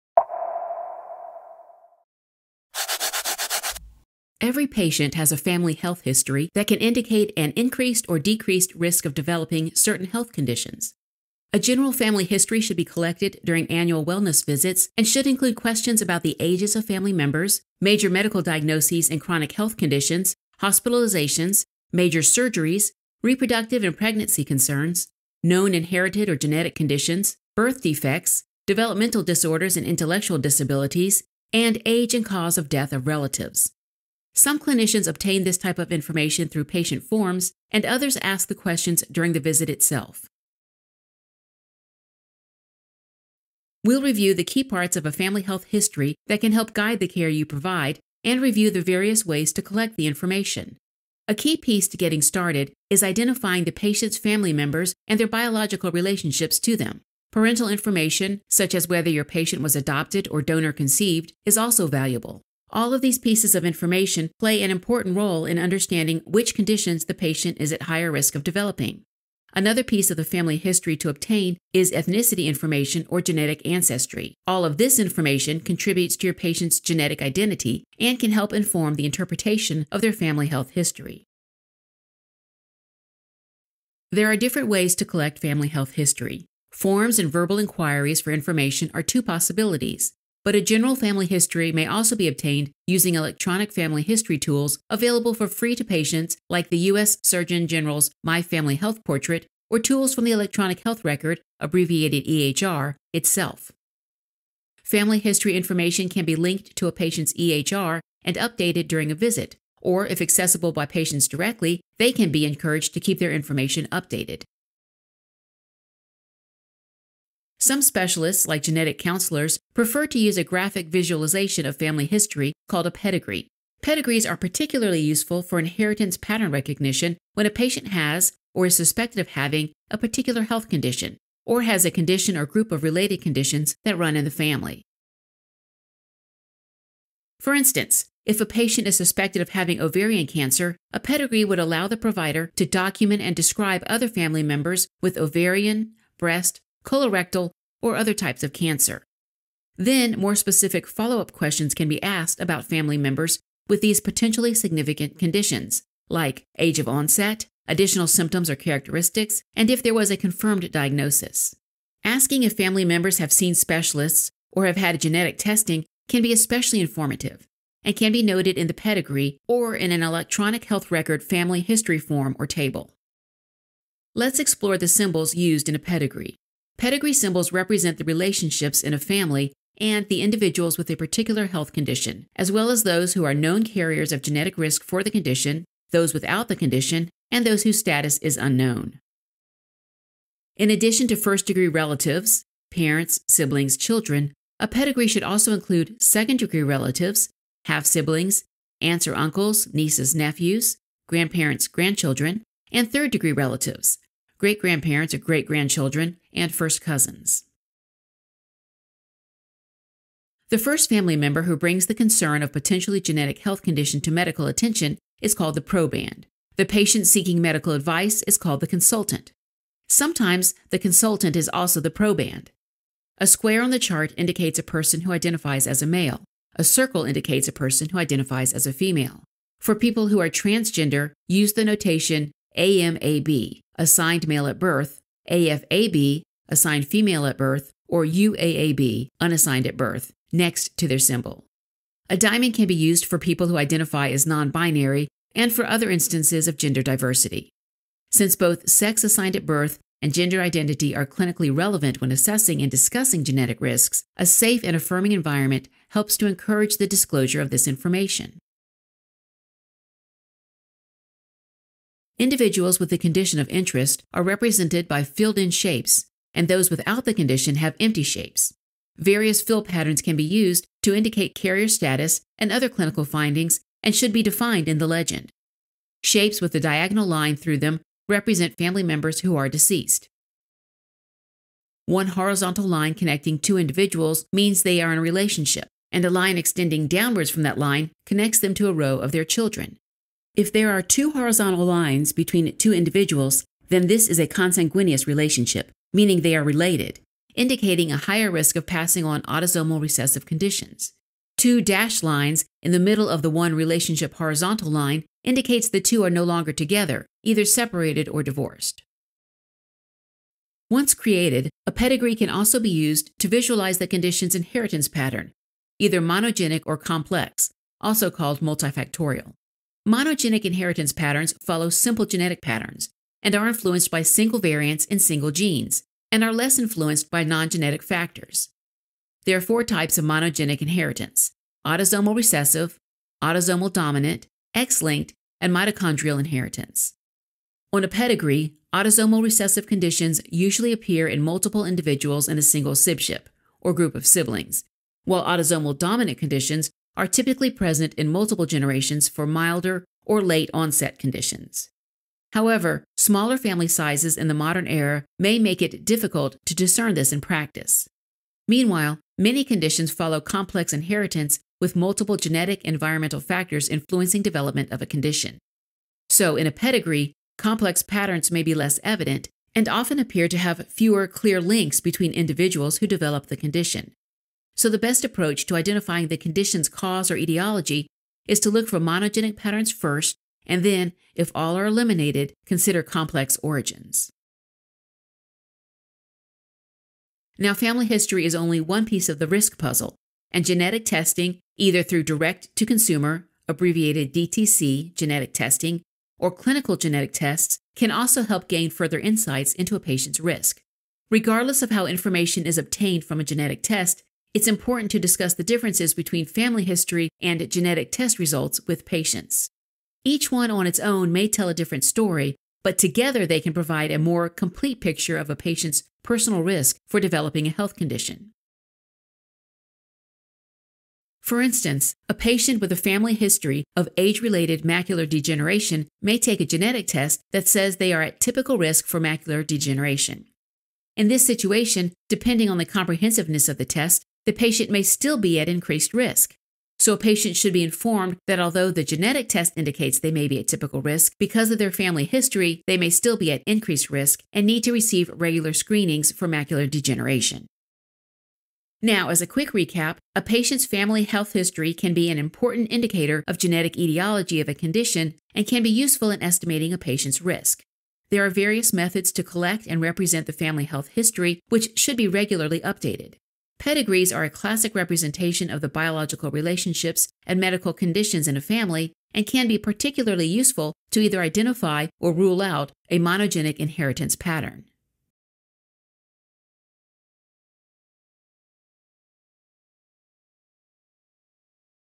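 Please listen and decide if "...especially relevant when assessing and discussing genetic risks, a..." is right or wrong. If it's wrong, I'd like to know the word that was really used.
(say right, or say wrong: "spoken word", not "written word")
wrong: "clinically", not "especially".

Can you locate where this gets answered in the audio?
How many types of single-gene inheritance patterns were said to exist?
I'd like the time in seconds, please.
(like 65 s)
329 s.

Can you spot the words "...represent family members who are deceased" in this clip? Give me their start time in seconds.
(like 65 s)
278 s.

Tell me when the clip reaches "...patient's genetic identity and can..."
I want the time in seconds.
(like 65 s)
76 s.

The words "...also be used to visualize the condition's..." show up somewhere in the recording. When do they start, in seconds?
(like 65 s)
312 s.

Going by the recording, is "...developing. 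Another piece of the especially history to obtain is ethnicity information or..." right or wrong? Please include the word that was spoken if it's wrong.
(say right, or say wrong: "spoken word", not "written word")
wrong: "family", not "especially".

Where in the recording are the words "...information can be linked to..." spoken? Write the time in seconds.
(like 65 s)
105 s.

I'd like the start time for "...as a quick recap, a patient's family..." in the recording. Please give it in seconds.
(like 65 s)
449 s.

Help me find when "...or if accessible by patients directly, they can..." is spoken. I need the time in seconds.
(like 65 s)
109 s.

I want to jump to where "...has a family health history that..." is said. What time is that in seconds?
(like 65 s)
5 s.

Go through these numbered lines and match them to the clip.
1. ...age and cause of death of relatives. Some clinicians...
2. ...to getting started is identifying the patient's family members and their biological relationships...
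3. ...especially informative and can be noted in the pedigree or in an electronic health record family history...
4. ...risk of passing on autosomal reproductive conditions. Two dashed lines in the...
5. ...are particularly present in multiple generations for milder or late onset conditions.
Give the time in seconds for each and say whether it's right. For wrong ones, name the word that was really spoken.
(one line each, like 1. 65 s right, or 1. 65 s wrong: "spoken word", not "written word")
1. 31 s right
2. 51 s right
3. 166 s right
4. 298 s wrong: "recessive", not "reproductive"
5. 346 s wrong: "typically", not "particularly".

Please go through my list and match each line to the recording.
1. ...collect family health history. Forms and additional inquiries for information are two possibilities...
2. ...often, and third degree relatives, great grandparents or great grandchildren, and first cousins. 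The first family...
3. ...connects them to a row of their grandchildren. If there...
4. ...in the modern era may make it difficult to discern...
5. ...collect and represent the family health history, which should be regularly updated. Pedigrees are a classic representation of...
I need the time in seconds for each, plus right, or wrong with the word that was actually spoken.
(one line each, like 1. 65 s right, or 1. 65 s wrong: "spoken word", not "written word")
1. 85 s wrong: "verbal", not "additional"
2. 201 s wrong: "grandchildren", not "often"
3. 288 s wrong: "children", not "grandchildren"
4. 354 s right
5. 459 s right.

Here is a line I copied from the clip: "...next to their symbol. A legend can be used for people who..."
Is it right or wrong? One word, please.
wrong.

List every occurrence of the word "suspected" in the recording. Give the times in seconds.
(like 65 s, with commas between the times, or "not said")
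128 s, 138 s.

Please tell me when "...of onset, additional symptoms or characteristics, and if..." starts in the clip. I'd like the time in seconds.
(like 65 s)
156 s.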